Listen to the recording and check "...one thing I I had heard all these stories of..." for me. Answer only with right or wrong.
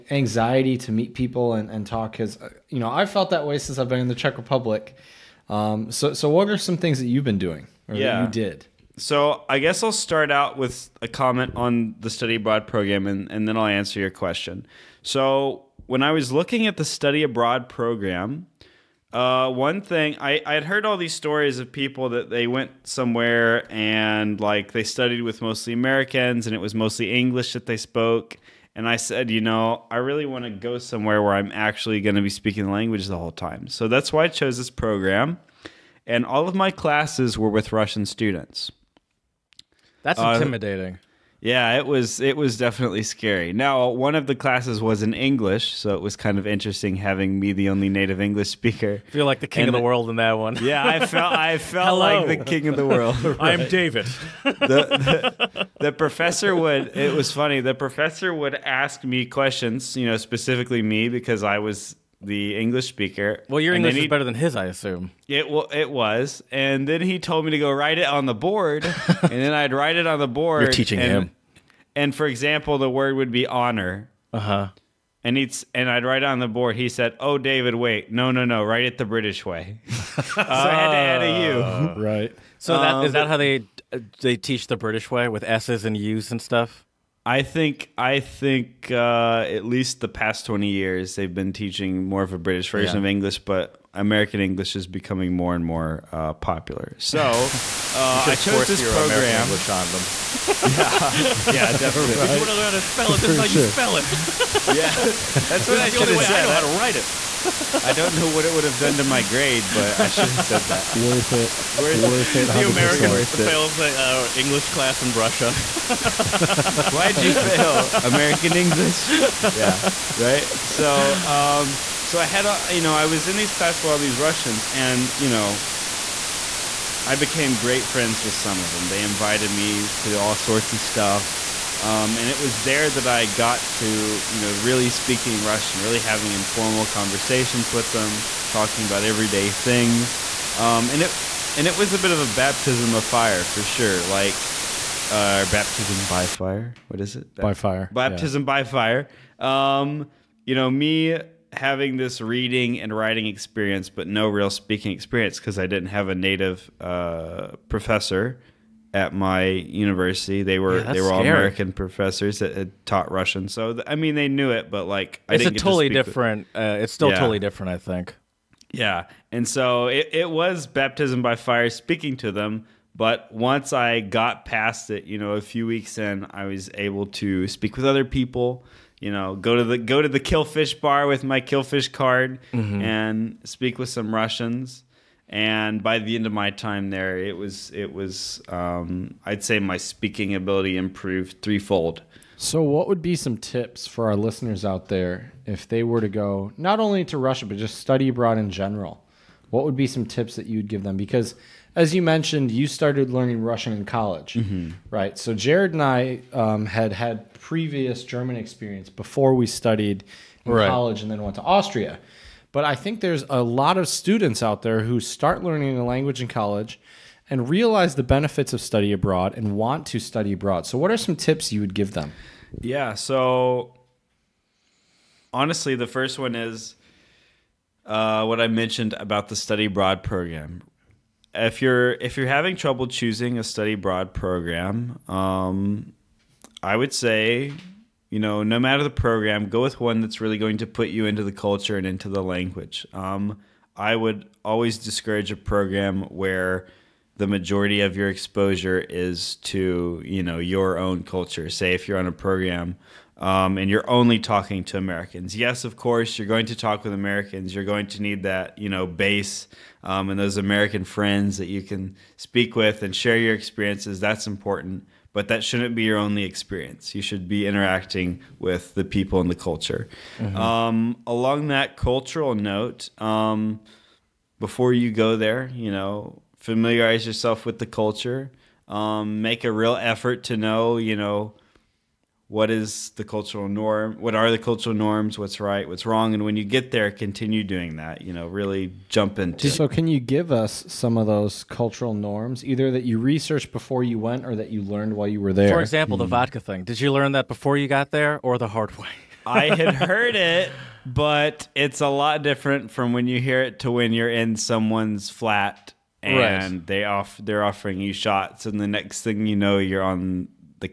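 right.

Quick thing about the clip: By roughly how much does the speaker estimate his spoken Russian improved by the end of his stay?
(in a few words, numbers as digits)
threefold.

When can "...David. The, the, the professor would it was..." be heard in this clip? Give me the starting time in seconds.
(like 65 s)
53 s.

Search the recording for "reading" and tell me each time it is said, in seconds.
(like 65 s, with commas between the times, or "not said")
152 s.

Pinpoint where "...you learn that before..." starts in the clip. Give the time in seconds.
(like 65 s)
296 s.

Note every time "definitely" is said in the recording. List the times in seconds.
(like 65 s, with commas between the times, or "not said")
42 s, 101 s.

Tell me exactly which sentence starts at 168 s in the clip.
Yeah, and so it, it was baptism by fire, speaking to them.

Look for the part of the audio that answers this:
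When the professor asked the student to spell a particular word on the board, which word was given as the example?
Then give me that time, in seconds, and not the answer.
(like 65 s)
73 s.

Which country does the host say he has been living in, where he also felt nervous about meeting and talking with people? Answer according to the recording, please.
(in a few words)
Czech Republic.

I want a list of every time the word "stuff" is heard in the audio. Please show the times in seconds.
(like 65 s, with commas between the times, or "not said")
86 s, 130 s.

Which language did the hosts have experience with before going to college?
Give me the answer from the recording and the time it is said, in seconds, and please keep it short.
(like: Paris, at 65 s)
German, at 208 s.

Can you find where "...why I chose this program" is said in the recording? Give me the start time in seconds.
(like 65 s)
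34 s.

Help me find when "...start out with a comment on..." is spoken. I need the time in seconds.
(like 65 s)
9 s.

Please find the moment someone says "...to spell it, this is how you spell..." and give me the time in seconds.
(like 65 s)
102 s.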